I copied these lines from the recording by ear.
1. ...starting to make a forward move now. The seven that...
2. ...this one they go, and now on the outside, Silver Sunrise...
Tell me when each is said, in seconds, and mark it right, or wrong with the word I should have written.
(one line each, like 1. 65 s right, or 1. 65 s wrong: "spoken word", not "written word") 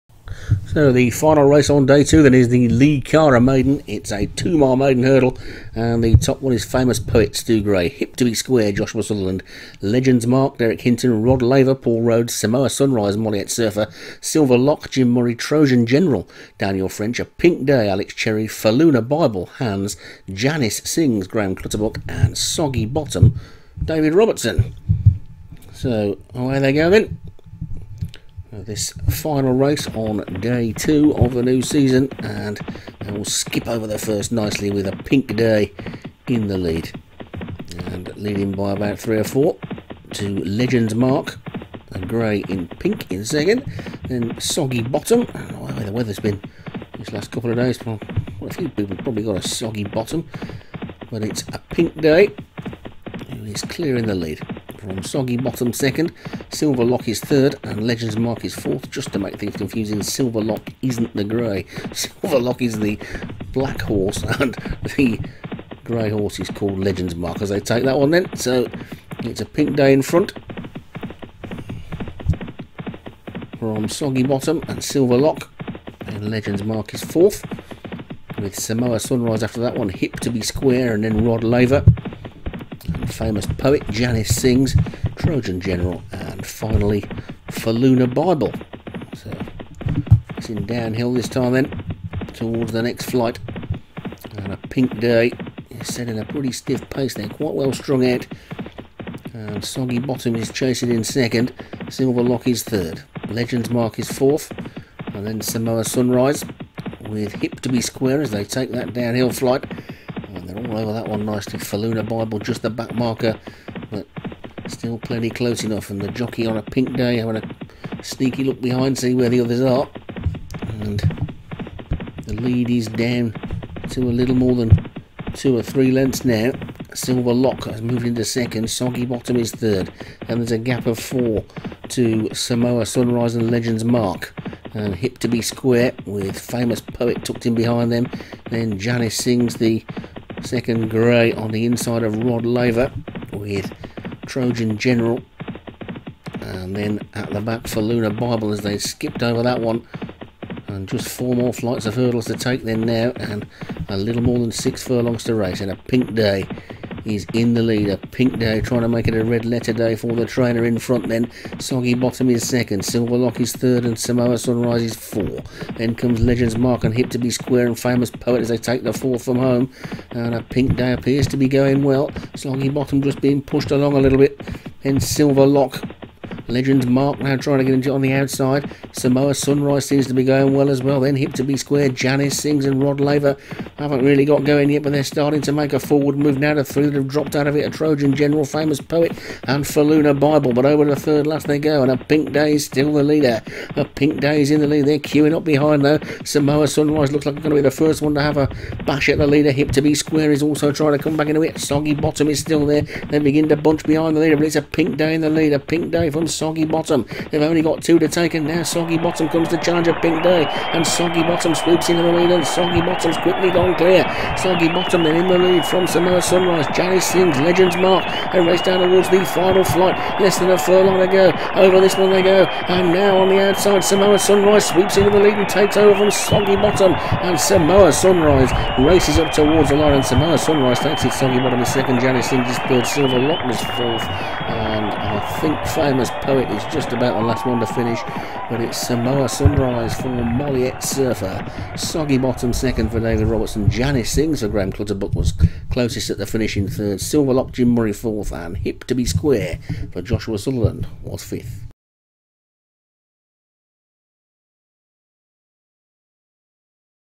1. 185 s wrong: "three", not "seven"
2. 221 s wrong: "Samoa", not "Silver".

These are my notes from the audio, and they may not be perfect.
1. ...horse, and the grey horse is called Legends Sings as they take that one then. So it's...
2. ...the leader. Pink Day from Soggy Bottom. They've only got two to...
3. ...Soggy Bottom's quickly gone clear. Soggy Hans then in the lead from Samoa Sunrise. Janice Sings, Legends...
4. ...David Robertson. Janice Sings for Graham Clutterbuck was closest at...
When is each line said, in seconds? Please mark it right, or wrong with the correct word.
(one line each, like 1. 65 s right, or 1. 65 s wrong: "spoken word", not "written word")
1. 63 s wrong: "Mark", not "Sings"
2. 205 s right
3. 212 s wrong: "Bottom", not "Hans"
4. 242 s right.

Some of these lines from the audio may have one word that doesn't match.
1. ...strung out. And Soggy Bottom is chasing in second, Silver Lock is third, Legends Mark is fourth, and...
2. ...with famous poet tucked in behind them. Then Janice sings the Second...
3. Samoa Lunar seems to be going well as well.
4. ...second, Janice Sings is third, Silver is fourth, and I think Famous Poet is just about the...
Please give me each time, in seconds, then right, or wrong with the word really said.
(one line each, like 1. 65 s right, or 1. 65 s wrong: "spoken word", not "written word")
1. 97 s right
2. 136 s right
3. 178 s wrong: "Sunrise", not "Lunar"
4. 231 s right.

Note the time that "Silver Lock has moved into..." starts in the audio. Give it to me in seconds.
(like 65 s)
126 s.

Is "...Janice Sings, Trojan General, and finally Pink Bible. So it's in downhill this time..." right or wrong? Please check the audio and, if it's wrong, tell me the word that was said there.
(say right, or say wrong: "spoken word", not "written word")
wrong: "Faluna", not "Pink".